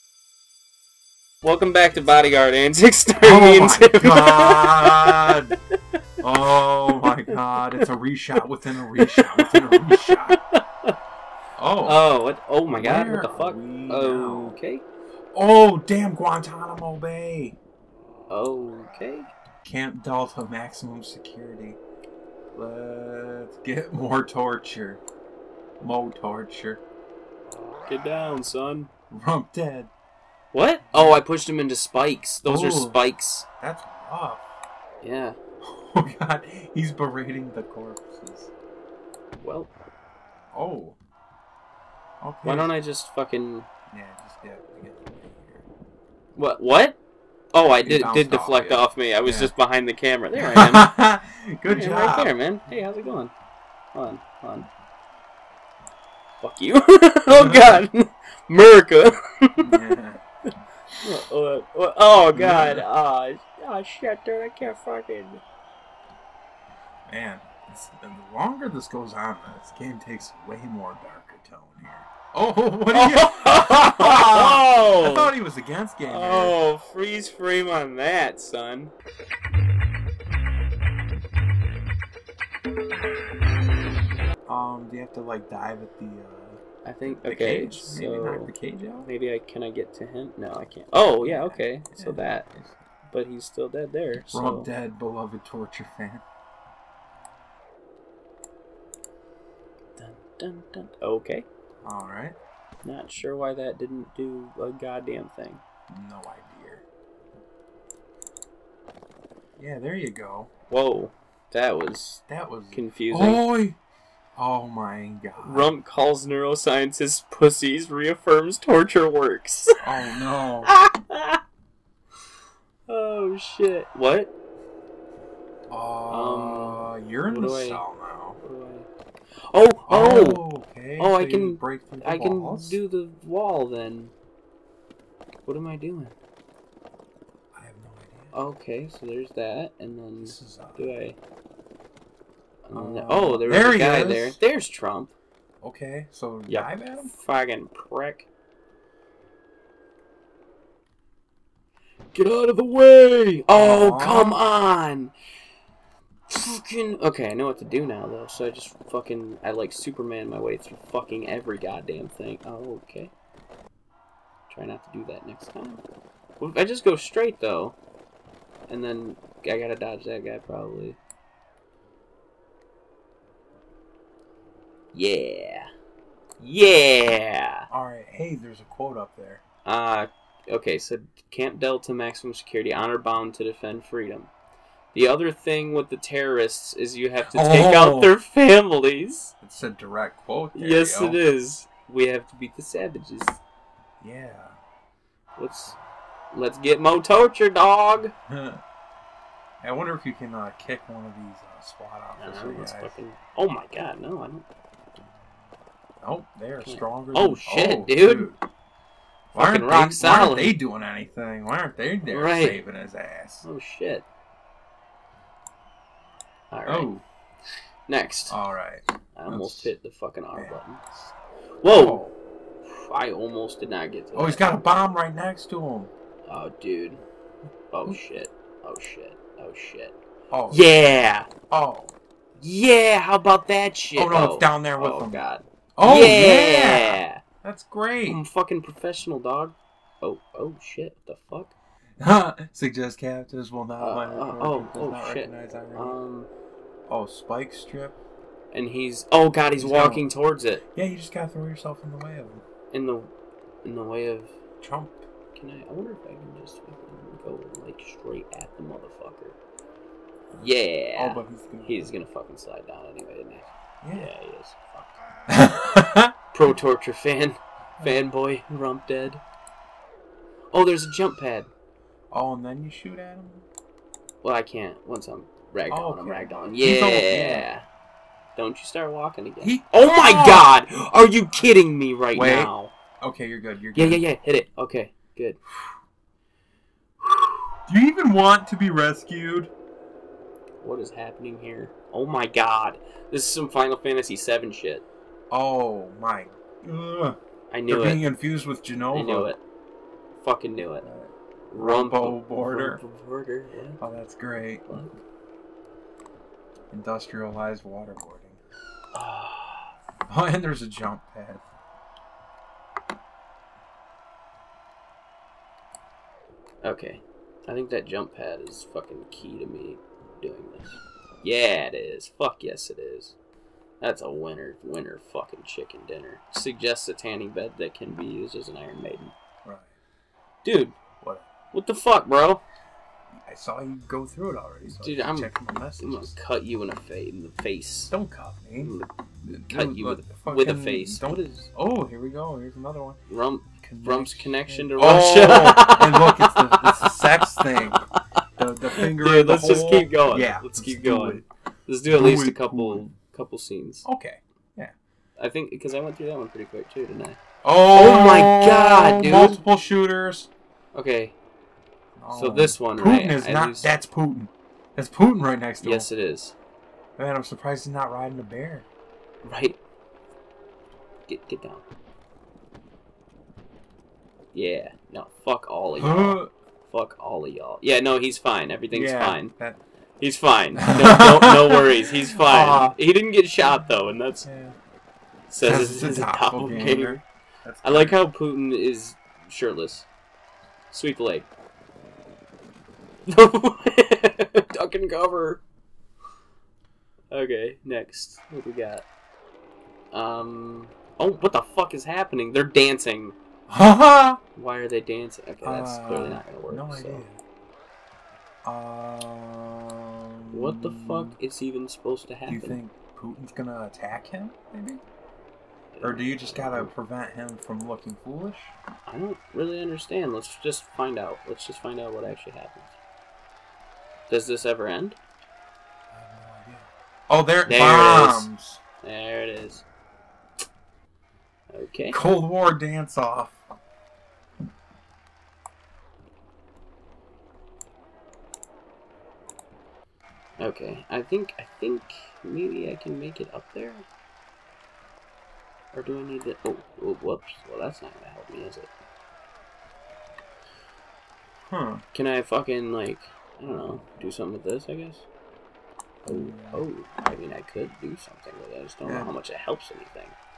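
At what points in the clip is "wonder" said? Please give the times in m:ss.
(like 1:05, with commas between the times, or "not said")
3:19, 4:15.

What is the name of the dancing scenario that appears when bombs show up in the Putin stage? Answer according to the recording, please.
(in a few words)
Cold War dance off.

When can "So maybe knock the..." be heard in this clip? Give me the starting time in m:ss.
1:27.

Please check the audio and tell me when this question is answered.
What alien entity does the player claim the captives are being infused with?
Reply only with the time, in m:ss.
4:58.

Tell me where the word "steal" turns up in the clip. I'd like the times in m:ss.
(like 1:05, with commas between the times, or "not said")
not said.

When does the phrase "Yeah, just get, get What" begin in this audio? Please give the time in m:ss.
0:43.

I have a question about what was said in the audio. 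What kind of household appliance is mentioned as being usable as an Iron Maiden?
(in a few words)
tanning bed.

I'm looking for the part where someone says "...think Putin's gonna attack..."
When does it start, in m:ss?
6:52.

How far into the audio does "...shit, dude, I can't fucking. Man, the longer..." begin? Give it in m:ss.
1:03.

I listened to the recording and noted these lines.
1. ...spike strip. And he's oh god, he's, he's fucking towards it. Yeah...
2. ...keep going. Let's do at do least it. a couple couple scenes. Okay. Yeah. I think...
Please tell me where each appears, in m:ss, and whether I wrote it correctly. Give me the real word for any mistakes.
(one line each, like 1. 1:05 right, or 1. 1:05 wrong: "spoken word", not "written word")
1. 4:07 wrong: "walking", not "fucking"
2. 5:50 right.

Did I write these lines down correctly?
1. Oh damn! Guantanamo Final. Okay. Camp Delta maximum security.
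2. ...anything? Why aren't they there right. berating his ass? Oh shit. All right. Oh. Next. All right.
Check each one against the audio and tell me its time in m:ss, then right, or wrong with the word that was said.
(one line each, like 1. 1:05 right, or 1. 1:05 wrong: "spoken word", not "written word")
1. 0:15 wrong: "Bay", not "Final"
2. 3:30 wrong: "saving", not "berating".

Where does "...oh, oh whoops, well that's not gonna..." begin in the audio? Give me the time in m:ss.
7:26.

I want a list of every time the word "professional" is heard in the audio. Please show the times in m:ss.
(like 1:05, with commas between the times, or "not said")
3:58.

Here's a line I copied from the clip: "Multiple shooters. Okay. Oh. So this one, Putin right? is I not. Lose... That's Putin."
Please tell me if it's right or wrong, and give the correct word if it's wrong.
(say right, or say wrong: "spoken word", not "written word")
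right.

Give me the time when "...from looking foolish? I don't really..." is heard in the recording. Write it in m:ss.
6:57.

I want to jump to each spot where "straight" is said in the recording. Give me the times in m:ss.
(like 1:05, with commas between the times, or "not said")
2:46, 4:17.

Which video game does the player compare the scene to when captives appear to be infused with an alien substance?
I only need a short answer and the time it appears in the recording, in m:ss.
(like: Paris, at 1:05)
Final Fantasy VII, at 4:53.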